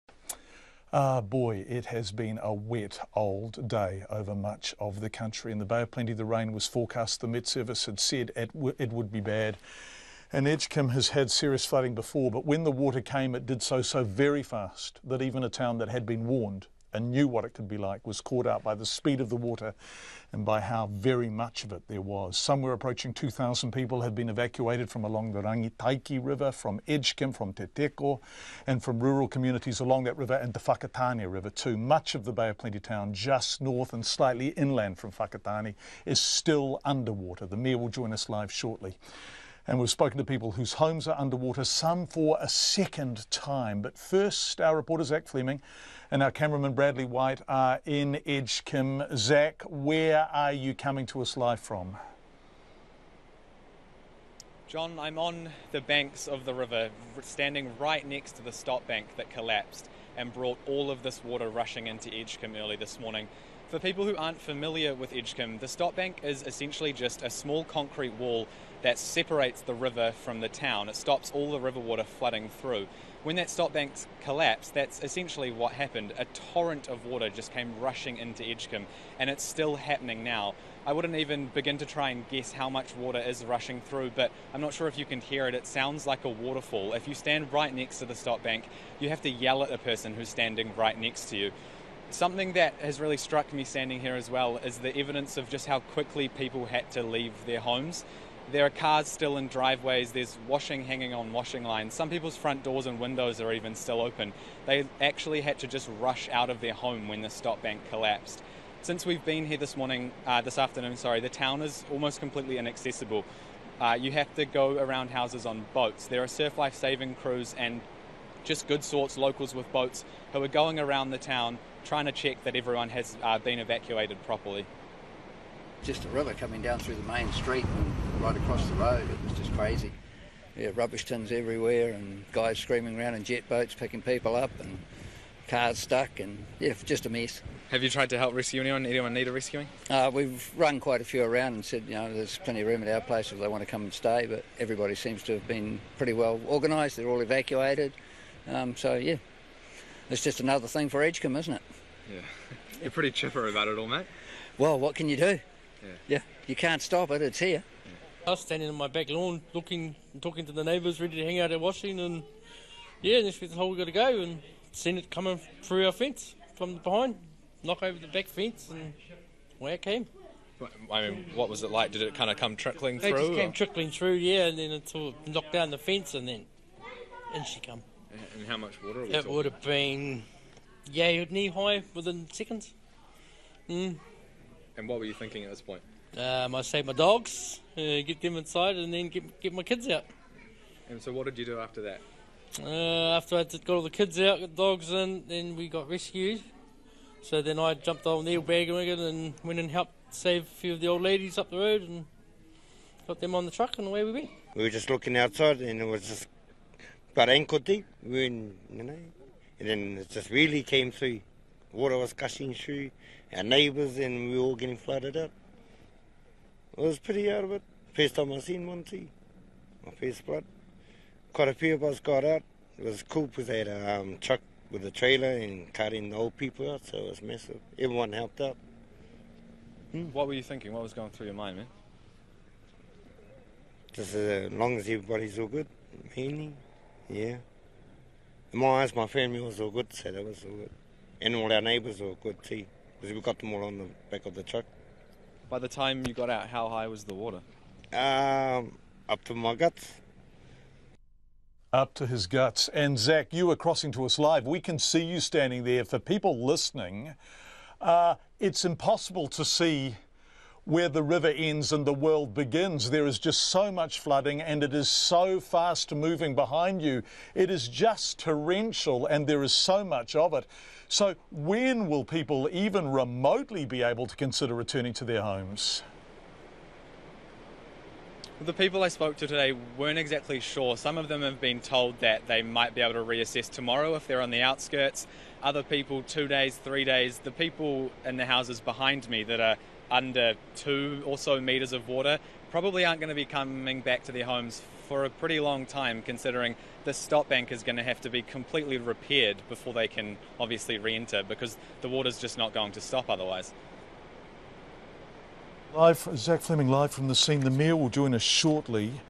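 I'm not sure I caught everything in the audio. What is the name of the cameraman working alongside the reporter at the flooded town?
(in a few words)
Bradley White.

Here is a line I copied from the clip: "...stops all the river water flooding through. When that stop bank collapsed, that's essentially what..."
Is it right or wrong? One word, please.
right.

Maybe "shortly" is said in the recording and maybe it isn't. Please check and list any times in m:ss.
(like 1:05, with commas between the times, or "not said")
0:38, 5:08.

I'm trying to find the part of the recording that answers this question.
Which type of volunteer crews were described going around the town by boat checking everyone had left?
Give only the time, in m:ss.
1:56.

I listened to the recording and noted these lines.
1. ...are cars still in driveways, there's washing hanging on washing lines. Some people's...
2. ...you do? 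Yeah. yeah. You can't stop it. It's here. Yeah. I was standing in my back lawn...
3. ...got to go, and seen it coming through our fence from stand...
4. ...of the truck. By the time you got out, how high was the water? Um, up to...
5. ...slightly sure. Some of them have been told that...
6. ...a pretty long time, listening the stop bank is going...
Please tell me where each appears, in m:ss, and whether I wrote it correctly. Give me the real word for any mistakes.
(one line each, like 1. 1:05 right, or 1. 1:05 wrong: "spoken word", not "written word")
1. 1:38 right
2. 2:35 right
3. 2:43 wrong: "behind", not "stand"
4. 4:04 right
5. 4:39 wrong: "exactly", not "slightly"
6. 4:55 wrong: "considering", not "listening".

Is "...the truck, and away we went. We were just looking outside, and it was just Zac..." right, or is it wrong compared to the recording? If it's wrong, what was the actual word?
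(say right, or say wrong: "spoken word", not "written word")
wrong: "Parenkote", not "Zac".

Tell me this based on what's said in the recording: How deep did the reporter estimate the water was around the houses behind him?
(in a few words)
2 meters.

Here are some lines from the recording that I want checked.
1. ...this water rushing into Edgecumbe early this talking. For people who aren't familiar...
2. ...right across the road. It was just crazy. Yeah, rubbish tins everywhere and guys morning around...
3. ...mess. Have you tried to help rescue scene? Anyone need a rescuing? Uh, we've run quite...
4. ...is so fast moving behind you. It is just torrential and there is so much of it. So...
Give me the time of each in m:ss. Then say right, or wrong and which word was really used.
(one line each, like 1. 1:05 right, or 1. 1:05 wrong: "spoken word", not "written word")
1. 1:01 wrong: "morning", not "talking"
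2. 2:08 wrong: "screaming", not "morning"
3. 2:17 wrong: "anyone", not "scene"
4. 4:24 right.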